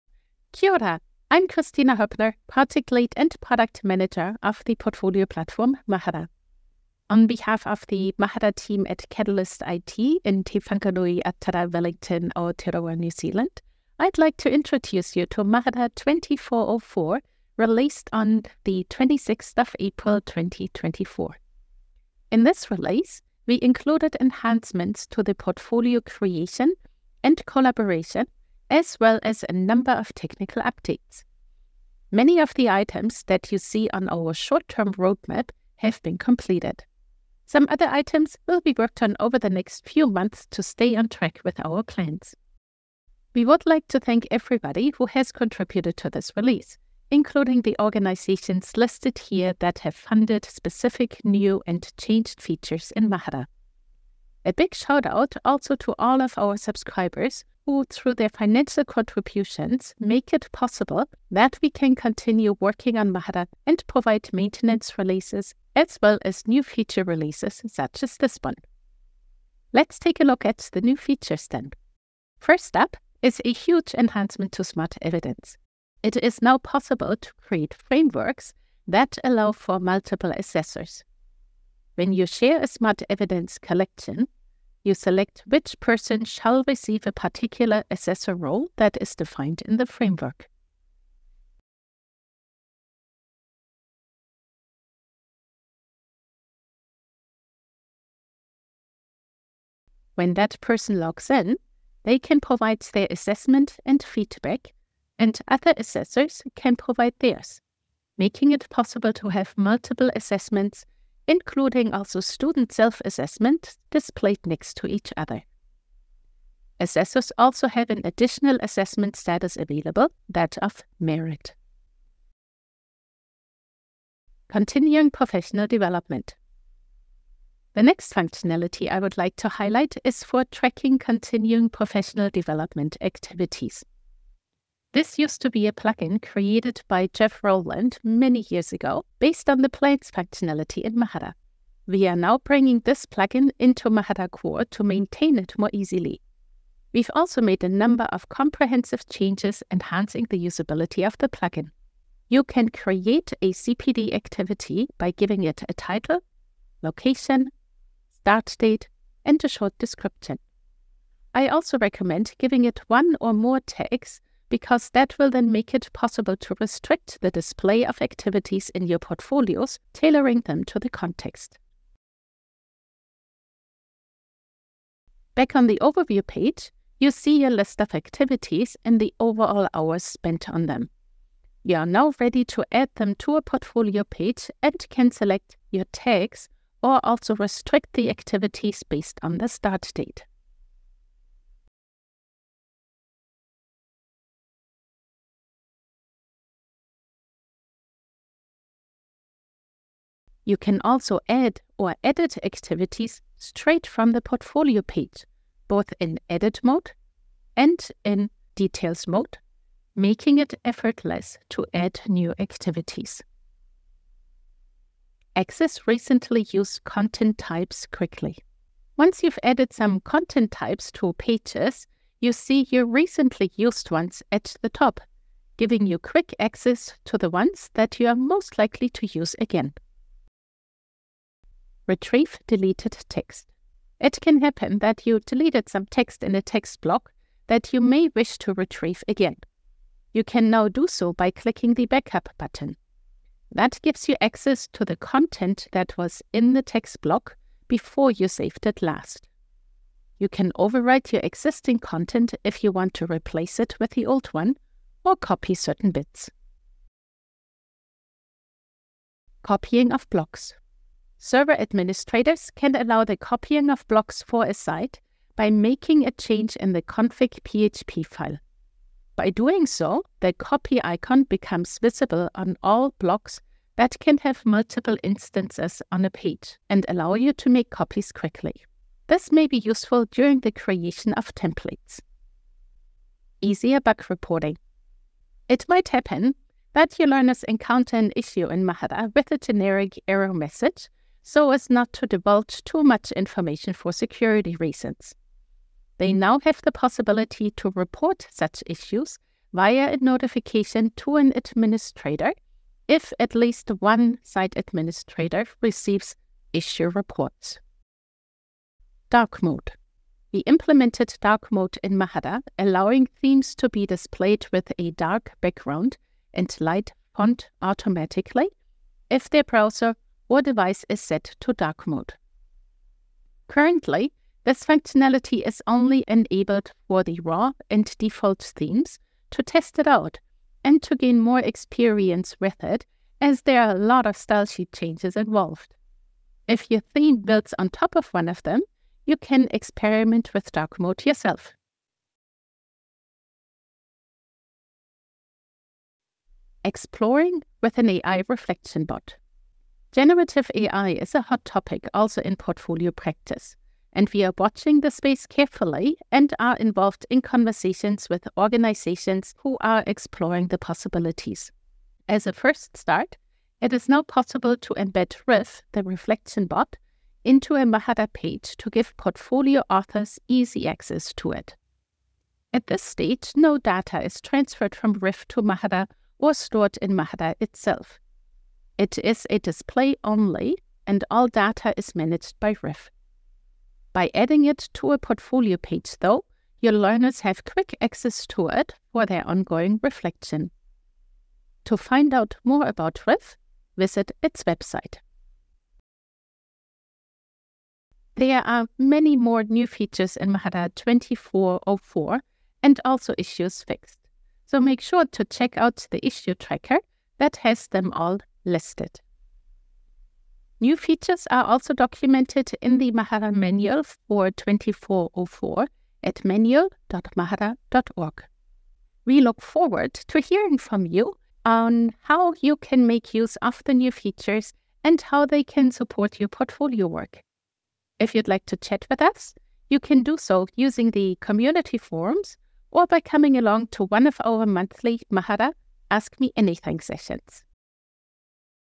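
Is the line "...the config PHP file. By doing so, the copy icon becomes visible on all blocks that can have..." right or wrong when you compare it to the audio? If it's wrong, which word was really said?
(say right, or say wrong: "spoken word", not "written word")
right.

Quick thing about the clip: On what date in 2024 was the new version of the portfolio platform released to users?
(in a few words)
26 April 2024.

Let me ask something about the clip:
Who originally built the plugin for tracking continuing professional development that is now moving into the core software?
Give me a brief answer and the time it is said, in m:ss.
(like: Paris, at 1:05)
Jeff Rowland, at 2:17.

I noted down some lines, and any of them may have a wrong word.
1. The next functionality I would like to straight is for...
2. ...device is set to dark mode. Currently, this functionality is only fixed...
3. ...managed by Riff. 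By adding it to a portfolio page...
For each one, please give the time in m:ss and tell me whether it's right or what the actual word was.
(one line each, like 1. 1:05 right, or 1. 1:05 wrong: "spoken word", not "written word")
1. 2:07 wrong: "highlight", not "straight"
2. 5:20 wrong: "enabled", not "fixed"
3. 6:21 right.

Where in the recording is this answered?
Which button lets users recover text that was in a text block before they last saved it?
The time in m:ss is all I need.
4:01.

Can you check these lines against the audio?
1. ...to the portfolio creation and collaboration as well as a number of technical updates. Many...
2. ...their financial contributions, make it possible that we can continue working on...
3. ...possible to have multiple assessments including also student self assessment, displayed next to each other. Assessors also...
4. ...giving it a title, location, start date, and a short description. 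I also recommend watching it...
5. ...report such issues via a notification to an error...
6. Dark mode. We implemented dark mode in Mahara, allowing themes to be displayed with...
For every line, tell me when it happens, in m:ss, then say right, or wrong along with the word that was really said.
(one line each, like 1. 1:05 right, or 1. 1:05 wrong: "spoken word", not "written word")
1. 0:25 right
2. 0:58 right
3. 1:48 right
4. 2:35 wrong: "giving", not "watching"
5. 4:57 wrong: "administrator", not "error"
6. 5:09 right.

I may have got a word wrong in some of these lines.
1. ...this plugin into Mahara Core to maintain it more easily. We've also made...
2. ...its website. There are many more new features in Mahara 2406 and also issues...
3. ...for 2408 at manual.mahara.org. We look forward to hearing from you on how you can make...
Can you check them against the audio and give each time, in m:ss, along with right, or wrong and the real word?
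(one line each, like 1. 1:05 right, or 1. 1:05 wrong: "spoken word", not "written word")
1. 2:22 right
2. 6:34 wrong: "2404", not "2406"
3. 6:53 wrong: "2404", not "2408".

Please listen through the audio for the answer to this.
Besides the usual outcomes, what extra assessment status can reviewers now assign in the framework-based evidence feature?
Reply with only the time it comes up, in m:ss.
2:00.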